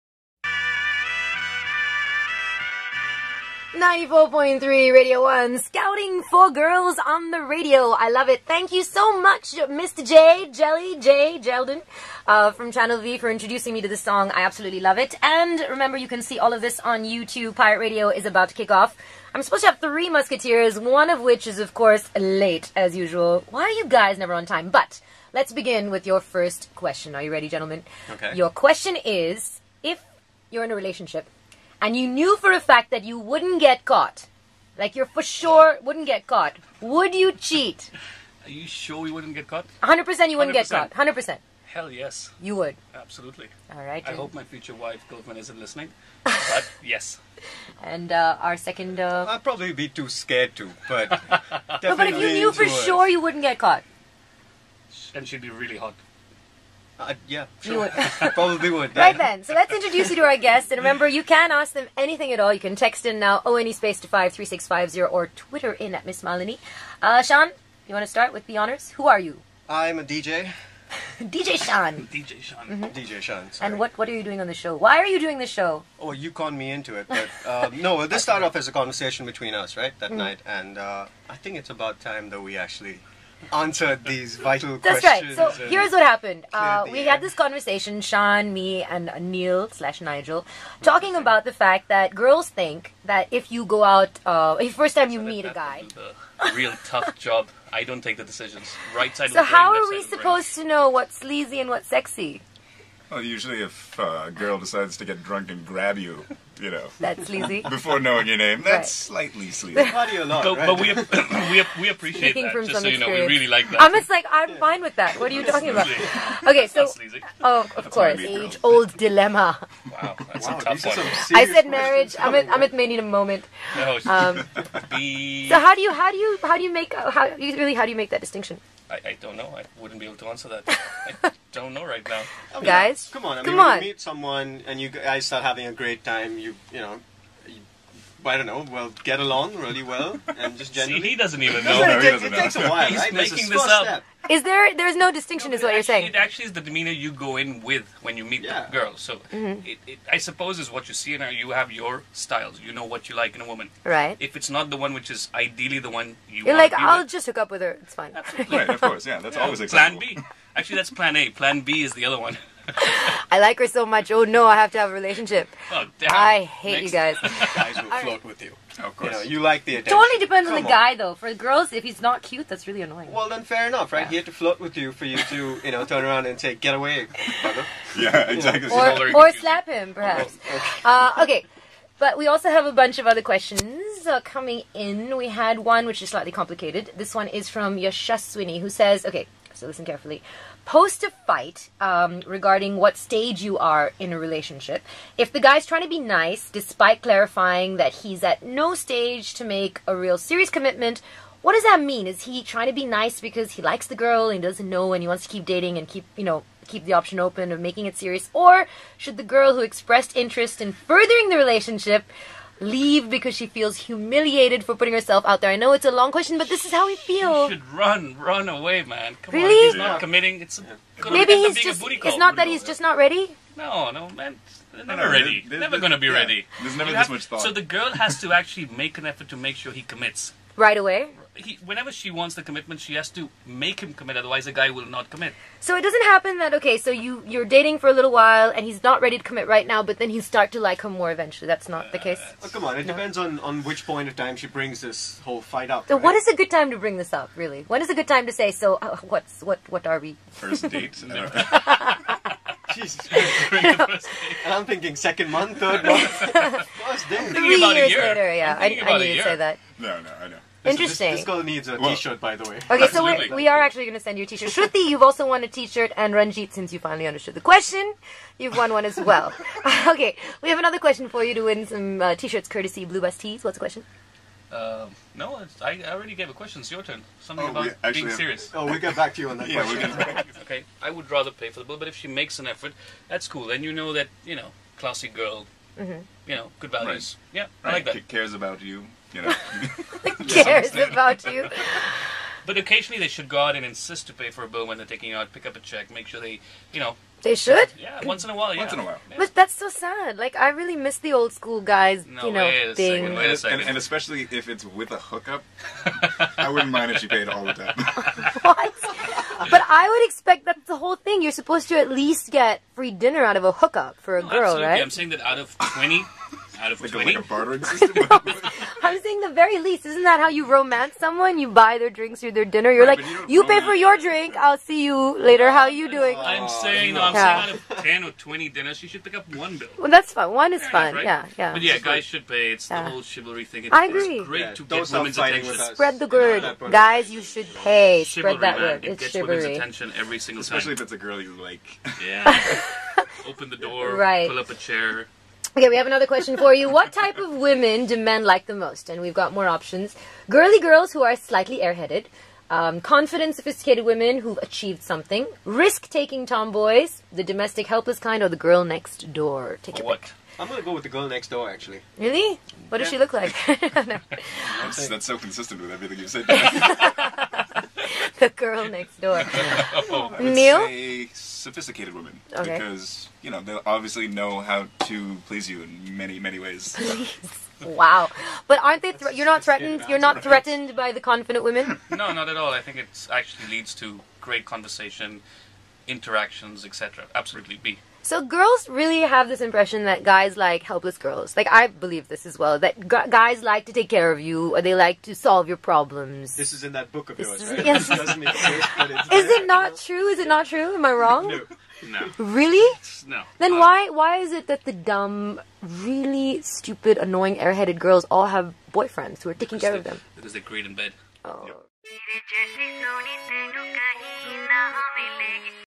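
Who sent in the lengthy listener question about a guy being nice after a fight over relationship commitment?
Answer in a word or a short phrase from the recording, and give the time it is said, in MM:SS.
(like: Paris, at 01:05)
Yashaswini, at 03:07.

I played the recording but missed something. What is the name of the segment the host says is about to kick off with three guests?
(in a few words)
Pirate Radio.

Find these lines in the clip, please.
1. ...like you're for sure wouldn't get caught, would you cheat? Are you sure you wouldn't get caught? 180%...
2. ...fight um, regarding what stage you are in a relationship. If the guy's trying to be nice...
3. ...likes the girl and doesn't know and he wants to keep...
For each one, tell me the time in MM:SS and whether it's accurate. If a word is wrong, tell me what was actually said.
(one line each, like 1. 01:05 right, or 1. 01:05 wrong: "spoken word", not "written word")
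1. 00:34 wrong: "100", not "180"
2. 03:11 right
3. 03:23 right.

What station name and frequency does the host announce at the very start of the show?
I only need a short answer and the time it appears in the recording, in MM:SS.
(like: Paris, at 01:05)
94.3 Radio 1, at 00:03.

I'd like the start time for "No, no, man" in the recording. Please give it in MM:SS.
03:43.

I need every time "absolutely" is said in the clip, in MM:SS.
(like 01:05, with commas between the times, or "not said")
00:14, 00:42, 02:38, 05:14, 06:27.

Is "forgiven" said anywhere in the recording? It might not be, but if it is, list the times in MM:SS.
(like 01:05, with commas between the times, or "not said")
not said.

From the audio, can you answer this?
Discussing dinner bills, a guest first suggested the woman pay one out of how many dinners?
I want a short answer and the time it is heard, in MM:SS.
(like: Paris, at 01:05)
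20, at 05:16.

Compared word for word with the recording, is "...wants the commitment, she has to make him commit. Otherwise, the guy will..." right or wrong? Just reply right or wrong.
right.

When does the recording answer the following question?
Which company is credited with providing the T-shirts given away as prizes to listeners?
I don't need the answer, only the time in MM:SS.
04:32.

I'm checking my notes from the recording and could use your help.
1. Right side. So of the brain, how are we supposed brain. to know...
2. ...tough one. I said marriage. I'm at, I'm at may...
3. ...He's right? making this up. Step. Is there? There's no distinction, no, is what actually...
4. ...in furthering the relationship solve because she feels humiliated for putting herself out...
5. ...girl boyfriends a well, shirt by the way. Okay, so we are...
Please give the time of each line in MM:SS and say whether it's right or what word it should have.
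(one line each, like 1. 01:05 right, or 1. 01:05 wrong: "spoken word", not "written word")
1. 01:38 right
2. 02:00 right
3. 02:22 right
4. 03:30 wrong: "leave", not "solve"
5. 04:21 wrong: "needs", not "boyfriends".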